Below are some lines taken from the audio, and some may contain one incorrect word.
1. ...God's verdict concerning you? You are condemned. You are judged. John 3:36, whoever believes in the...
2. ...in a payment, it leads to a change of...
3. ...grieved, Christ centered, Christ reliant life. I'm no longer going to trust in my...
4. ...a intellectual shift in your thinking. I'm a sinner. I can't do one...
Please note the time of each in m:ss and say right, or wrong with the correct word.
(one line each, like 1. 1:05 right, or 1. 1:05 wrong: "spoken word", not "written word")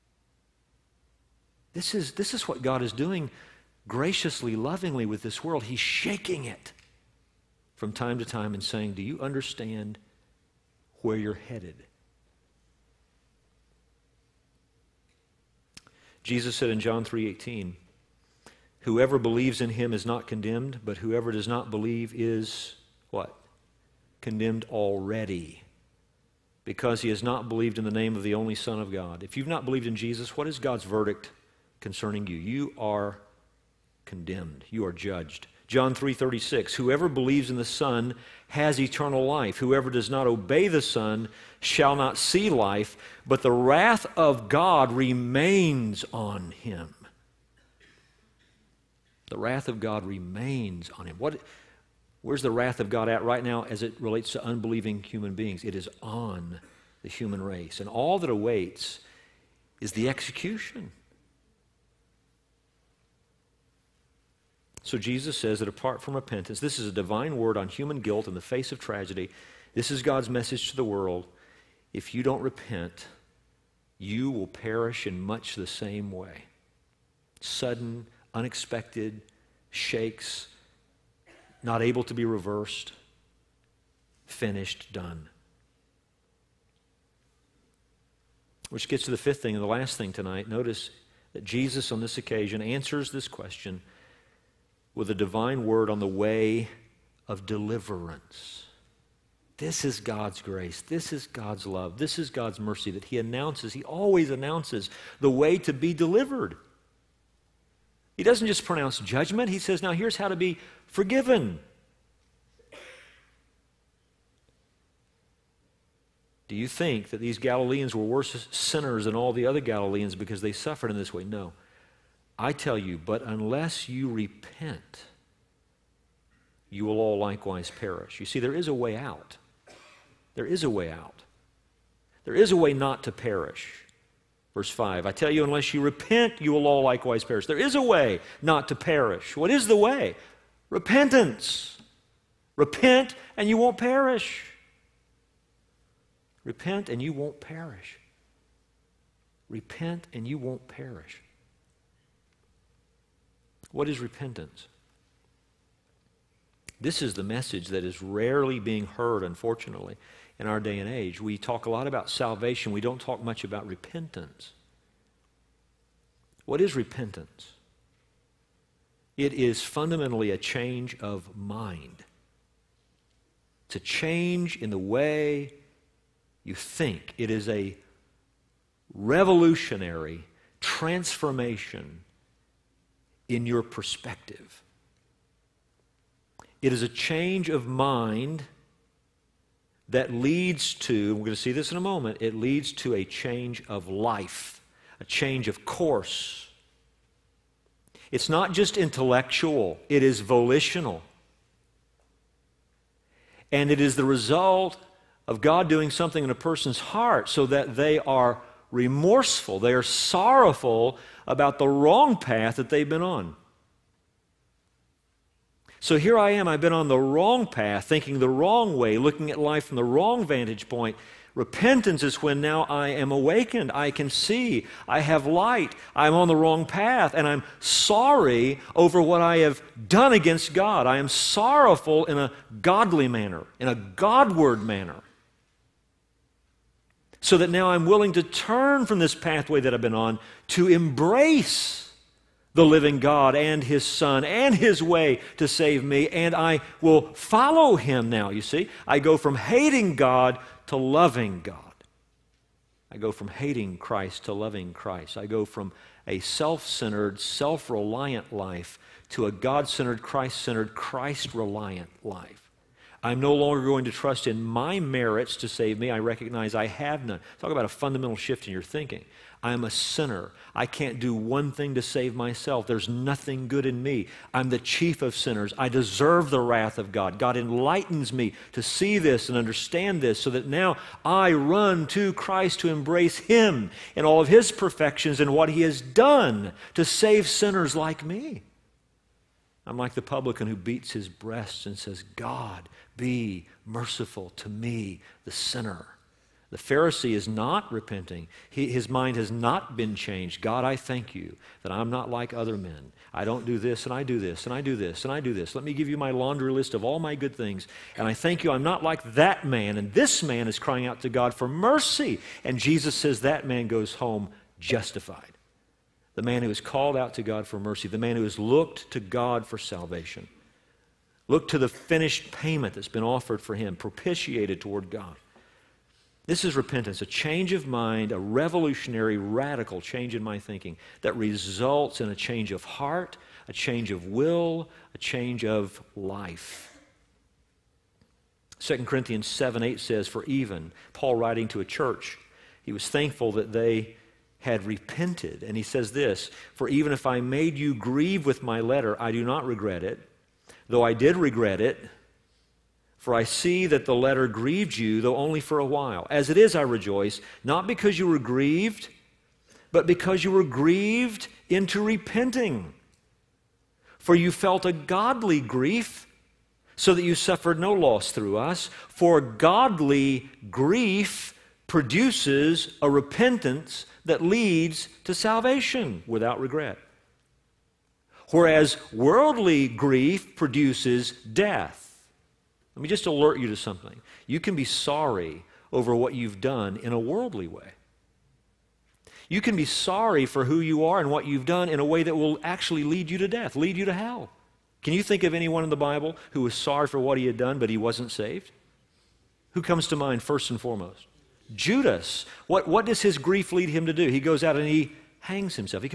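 1. 0:30 right
2. 3:11 wrong: "moment", not "payment"
3. 4:19 wrong: "centered", not "grieved"
4. 4:27 wrong: "fundamental", not "intellectual".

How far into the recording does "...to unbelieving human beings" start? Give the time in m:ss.
0:54.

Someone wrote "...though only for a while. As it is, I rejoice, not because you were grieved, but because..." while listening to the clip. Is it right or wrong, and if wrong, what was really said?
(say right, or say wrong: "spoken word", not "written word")
right.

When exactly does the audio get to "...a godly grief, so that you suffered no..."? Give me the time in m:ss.
6:04.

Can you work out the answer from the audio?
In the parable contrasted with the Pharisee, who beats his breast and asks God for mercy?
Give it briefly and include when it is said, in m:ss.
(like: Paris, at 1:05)
The publican, at 4:49.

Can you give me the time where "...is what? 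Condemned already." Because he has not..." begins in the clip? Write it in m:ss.
0:22.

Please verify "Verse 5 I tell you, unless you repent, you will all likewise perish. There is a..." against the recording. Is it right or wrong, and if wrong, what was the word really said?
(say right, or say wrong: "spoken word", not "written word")
right.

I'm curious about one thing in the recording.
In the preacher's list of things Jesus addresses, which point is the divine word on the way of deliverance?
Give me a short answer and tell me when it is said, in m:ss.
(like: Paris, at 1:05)
Fifth, at 1:29.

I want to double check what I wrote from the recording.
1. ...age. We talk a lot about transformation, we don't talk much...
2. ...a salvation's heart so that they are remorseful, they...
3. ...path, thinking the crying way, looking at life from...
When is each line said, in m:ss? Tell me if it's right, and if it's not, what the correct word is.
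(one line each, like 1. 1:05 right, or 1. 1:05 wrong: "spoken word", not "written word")
1. 2:40 wrong: "salvation", not "transformation"
2. 3:26 wrong: "person", not "salvation"
3. 3:37 wrong: "wrong", not "crying".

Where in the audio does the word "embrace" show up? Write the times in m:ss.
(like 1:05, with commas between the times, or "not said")
4:00, 4:42.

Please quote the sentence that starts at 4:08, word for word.
You see, I go from hating God to loving God.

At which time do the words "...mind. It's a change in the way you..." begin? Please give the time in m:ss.
2:51.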